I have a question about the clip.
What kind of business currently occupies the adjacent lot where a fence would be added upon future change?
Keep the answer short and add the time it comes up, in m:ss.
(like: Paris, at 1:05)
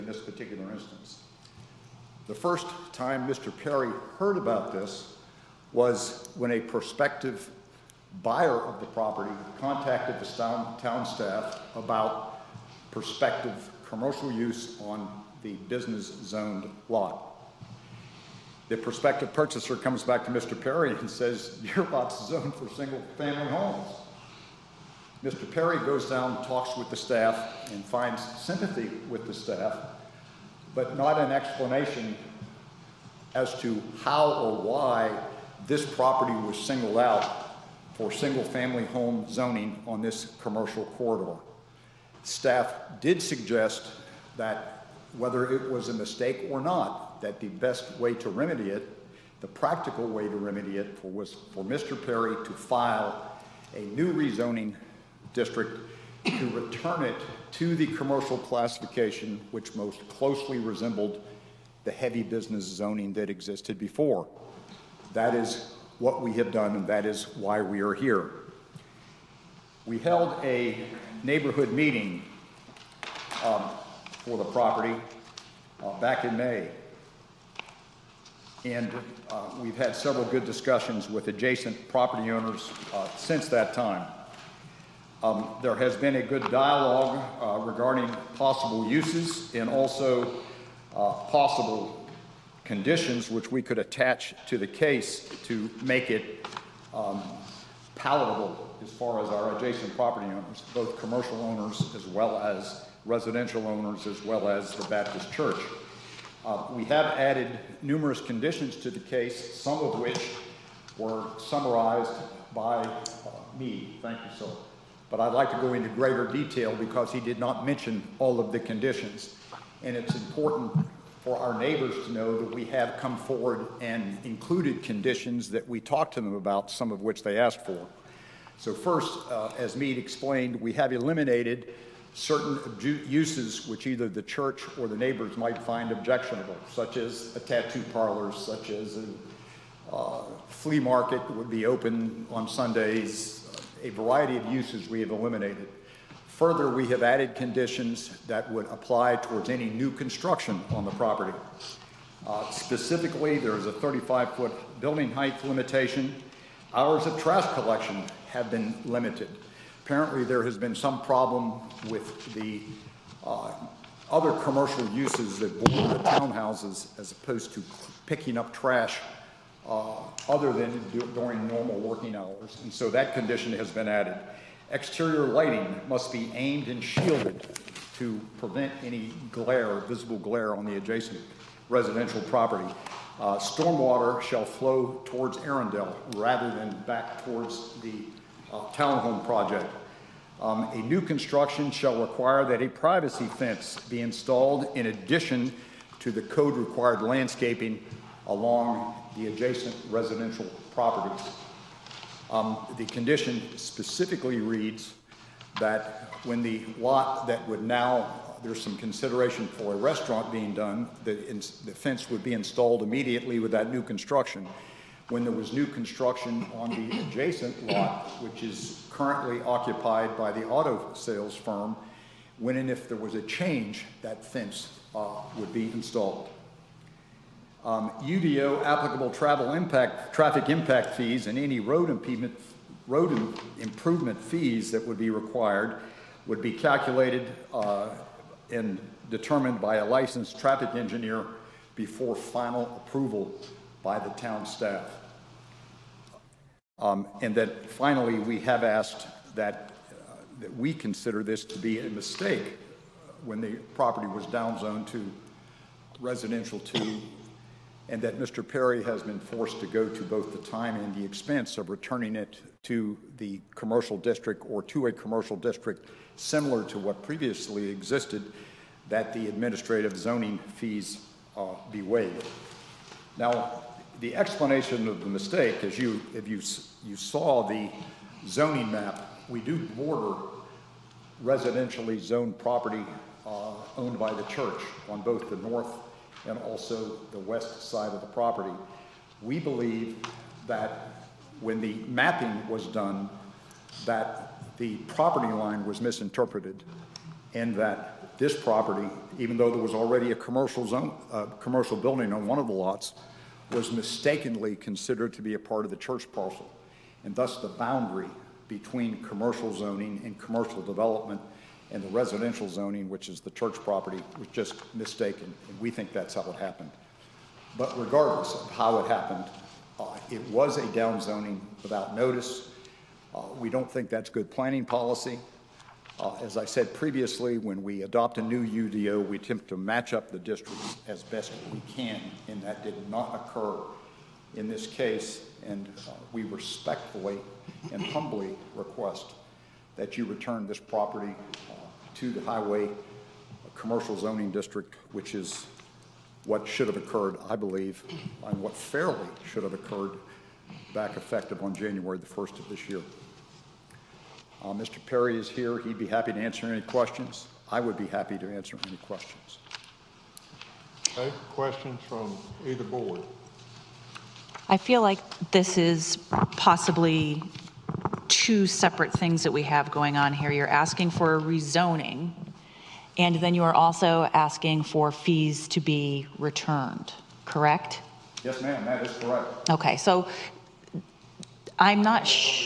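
auto sales firm, at 3:40.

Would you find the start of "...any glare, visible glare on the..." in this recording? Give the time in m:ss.
2:58.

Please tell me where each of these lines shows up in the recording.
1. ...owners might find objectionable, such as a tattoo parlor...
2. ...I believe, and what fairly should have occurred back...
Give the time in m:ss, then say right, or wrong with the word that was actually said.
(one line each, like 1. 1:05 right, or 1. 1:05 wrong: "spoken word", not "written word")
1. 2:14 wrong: "neighbors", not "owners"
2. 5:47 right.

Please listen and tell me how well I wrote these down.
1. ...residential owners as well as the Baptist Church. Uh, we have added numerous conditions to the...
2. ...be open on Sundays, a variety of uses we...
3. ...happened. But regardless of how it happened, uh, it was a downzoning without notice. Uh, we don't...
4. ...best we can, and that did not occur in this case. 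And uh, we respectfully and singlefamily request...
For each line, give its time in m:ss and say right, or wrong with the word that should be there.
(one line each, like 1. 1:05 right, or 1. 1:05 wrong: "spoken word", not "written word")
1. 1:43 right
2. 2:21 right
3. 5:16 right
4. 5:31 wrong: "humbly", not "singlefamily".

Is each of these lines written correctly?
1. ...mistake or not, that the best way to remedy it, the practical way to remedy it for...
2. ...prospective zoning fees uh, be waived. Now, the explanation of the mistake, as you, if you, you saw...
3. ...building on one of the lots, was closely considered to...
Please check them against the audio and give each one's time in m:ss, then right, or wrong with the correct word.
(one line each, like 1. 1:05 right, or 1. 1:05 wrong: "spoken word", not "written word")
1. 0:45 right
2. 4:29 wrong: "administrative", not "prospective"
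3. 5:01 wrong: "mistakenly", not "closely".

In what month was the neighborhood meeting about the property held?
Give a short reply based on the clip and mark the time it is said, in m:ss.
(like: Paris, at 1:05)
May, at 1:16.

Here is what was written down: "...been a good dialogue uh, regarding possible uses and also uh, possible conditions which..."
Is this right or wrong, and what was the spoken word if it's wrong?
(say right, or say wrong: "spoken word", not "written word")
right.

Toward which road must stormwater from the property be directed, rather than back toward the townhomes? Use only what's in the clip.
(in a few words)
Arendell.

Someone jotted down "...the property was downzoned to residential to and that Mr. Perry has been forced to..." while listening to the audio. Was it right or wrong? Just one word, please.
right.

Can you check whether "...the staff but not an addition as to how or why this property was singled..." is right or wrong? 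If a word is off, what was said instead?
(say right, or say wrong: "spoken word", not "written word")
wrong: "explanation", not "addition".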